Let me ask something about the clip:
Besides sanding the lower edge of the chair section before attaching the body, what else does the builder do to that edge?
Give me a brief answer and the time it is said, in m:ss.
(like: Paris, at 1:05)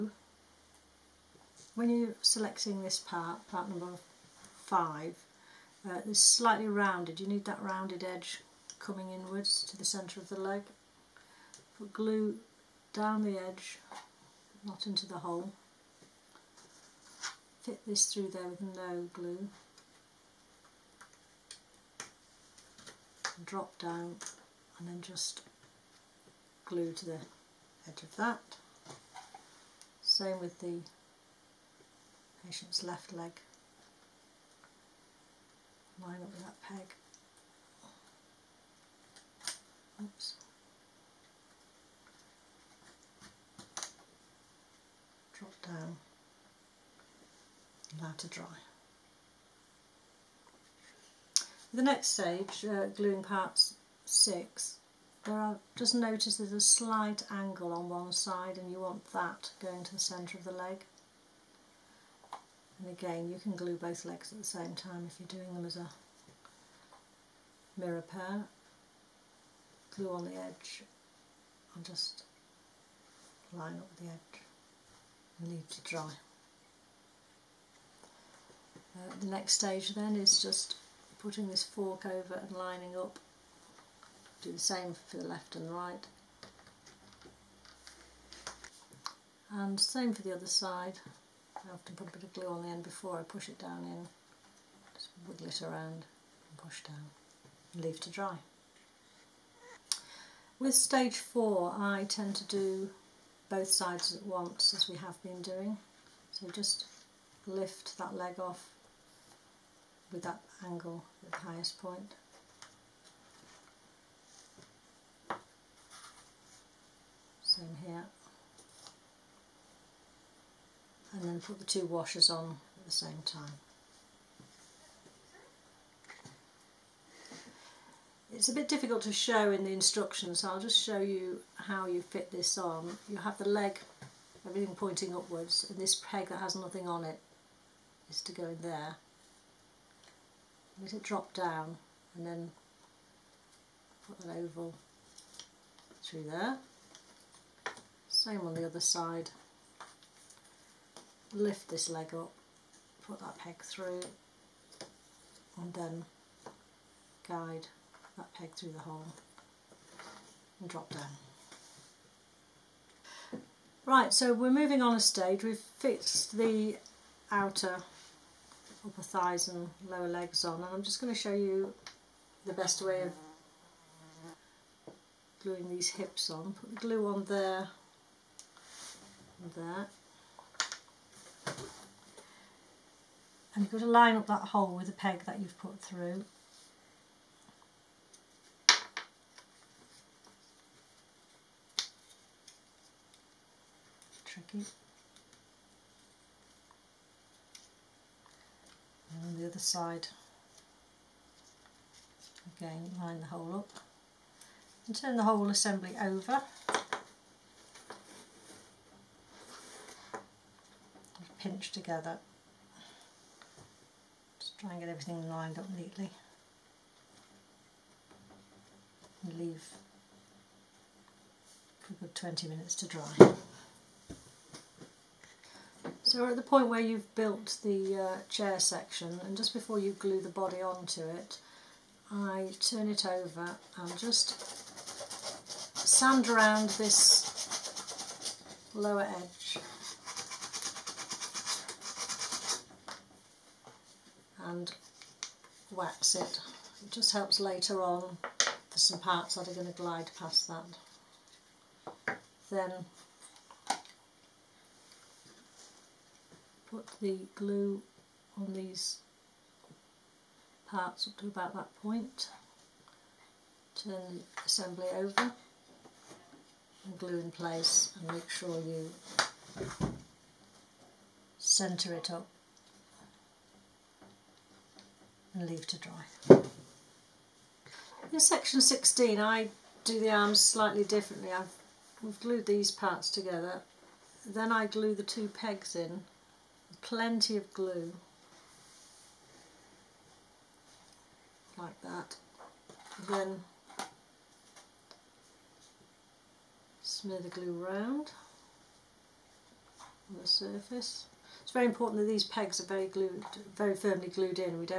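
Wax it, at 4:05.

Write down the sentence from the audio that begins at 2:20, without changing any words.
Let it drop down and then put an oval through there.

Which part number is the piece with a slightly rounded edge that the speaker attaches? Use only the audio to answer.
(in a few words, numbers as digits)
5.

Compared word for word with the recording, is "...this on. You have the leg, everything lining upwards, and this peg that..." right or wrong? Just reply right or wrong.
wrong.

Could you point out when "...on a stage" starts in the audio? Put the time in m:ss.
2:44.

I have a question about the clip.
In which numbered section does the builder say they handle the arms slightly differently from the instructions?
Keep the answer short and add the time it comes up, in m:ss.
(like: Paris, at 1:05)
16, at 4:38.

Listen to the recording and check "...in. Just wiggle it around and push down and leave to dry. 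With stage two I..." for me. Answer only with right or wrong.
wrong.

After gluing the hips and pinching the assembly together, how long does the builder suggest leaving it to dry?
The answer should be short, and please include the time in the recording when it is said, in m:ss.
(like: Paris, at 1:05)
20 minutes, at 3:42.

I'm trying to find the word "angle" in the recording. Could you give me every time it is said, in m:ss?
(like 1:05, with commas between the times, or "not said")
0:57, 1:50.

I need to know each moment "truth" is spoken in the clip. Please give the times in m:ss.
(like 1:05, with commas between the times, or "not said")
not said.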